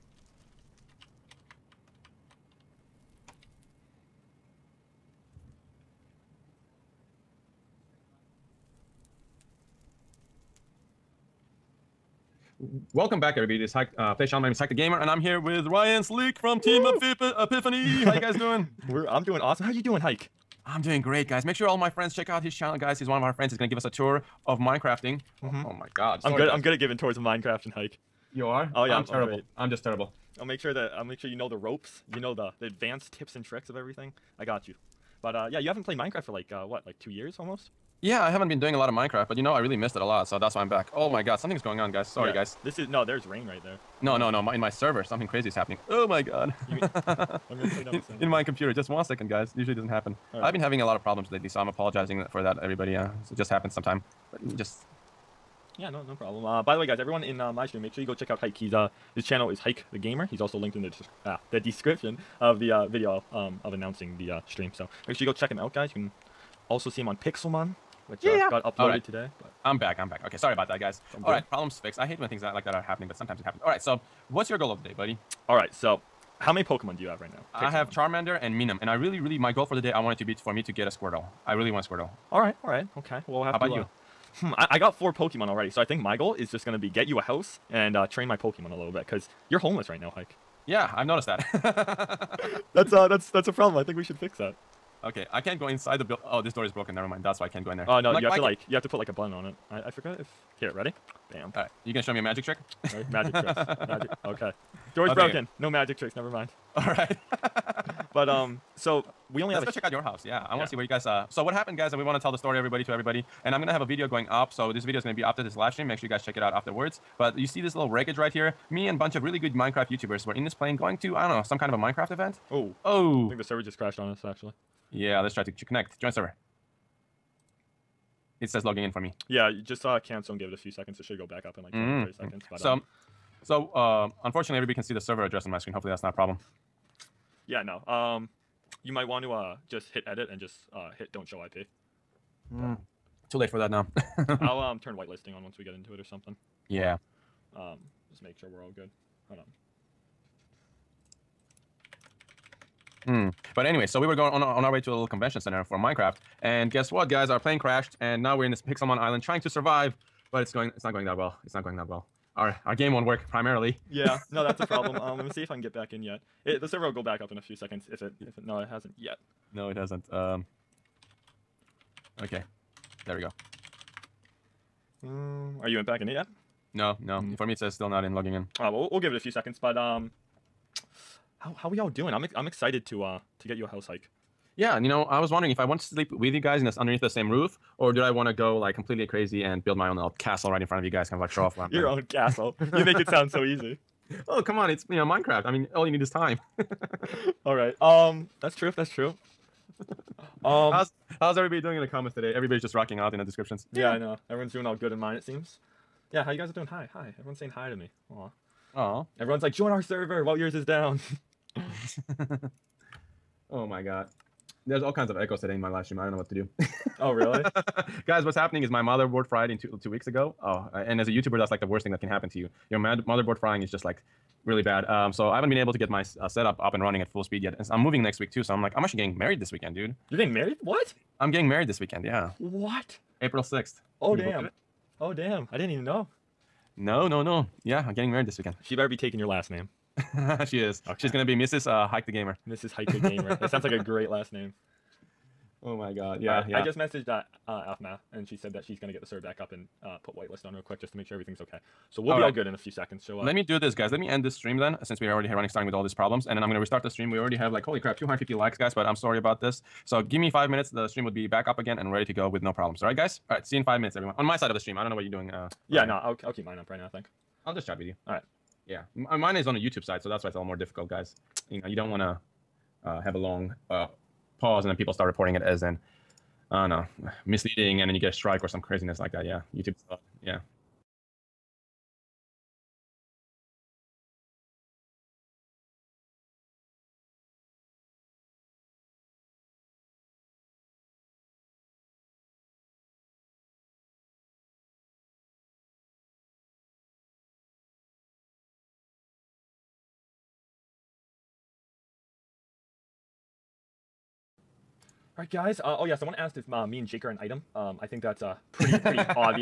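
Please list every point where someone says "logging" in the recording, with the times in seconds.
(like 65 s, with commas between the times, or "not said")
128 s, 178 s.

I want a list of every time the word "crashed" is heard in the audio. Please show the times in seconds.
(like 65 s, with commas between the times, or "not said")
123 s, 157 s.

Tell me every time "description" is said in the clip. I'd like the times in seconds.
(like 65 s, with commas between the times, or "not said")
61 s, 203 s.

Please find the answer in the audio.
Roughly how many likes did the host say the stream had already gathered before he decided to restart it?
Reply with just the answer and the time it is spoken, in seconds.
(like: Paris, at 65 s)
250, at 257 s.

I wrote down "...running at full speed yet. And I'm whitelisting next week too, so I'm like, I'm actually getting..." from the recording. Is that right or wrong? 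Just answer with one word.
wrong.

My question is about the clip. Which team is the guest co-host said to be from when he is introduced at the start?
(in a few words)
Team Epiphany.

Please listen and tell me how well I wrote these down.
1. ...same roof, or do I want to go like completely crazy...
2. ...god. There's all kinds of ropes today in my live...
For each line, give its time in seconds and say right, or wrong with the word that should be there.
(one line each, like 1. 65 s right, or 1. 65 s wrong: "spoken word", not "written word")
1. 187 s right
2. 213 s wrong: "echoes", not "ropes".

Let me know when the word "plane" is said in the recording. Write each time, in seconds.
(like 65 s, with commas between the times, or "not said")
120 s, 157 s.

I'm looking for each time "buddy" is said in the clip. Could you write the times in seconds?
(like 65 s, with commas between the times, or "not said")
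74 s.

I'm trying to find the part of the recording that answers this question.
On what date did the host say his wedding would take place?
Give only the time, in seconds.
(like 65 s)
233 s.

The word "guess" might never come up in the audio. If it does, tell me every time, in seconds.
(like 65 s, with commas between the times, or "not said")
156 s.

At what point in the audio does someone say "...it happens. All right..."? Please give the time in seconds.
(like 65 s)
73 s.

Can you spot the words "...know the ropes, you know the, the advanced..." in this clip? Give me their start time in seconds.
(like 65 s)
31 s.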